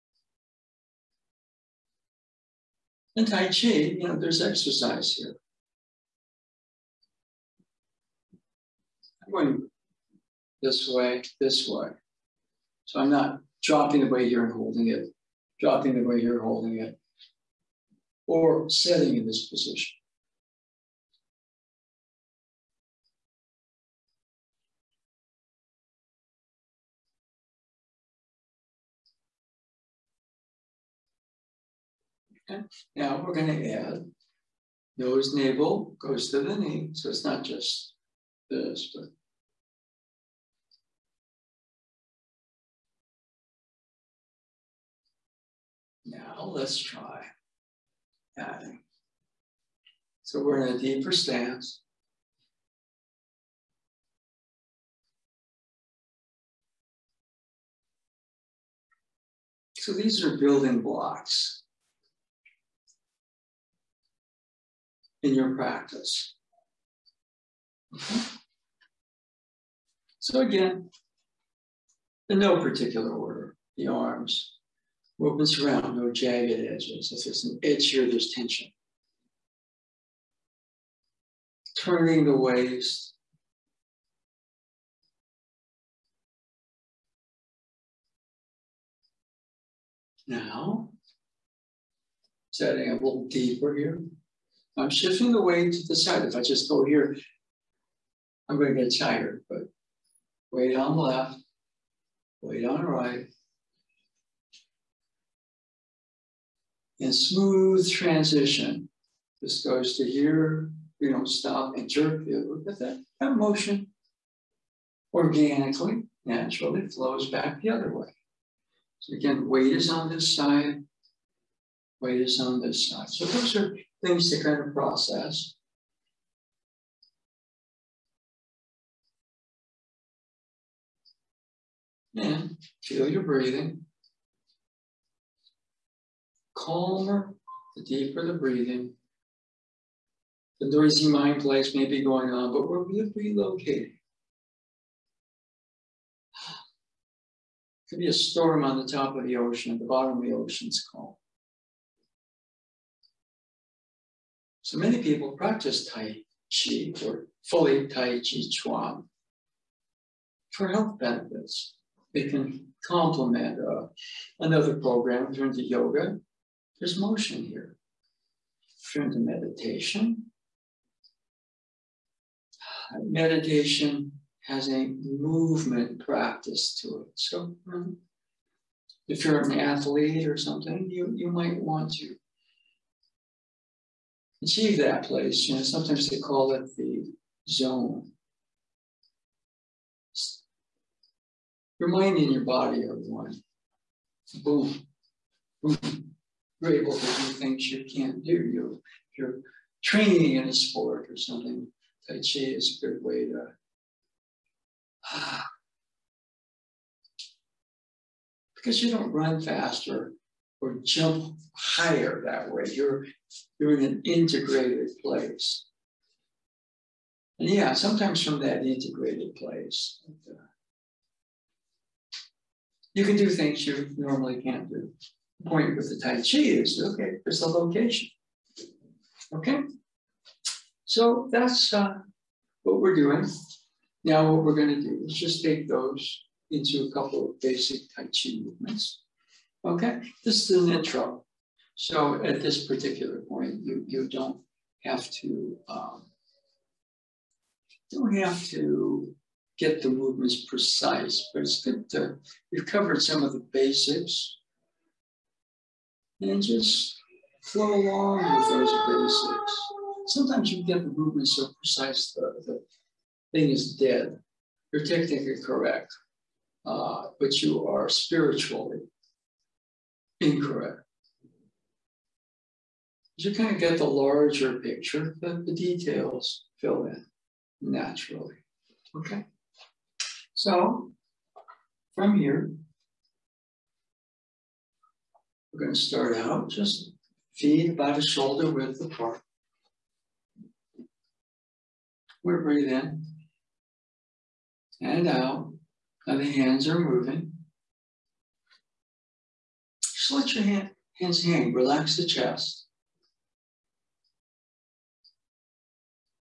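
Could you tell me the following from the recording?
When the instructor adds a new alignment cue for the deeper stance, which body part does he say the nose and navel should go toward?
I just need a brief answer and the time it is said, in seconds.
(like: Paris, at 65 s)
the knee, at 36 s.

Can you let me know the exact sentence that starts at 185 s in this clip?
You know, sometimes they call it the zone.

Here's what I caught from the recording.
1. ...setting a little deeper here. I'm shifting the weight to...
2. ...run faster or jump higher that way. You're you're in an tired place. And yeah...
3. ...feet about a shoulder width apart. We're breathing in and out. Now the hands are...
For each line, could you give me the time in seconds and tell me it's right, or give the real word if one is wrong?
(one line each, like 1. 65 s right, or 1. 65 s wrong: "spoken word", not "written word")
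1. 92 s right
2. 209 s wrong: "integrated", not "tired"
3. 287 s right.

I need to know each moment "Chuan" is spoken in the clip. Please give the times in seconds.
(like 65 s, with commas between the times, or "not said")
158 s.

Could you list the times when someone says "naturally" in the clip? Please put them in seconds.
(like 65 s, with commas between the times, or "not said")
116 s, 277 s.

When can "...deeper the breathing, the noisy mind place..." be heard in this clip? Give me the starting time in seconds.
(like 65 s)
137 s.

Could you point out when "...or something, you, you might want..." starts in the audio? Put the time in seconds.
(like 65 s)
180 s.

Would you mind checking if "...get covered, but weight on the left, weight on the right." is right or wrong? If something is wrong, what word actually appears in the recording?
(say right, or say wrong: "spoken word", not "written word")
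wrong: "tired", not "covered".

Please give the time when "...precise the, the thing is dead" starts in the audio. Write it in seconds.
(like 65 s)
261 s.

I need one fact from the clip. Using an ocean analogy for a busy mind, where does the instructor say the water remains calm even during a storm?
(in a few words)
at the bottom of the ocean.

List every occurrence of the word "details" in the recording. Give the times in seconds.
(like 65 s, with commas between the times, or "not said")
275 s.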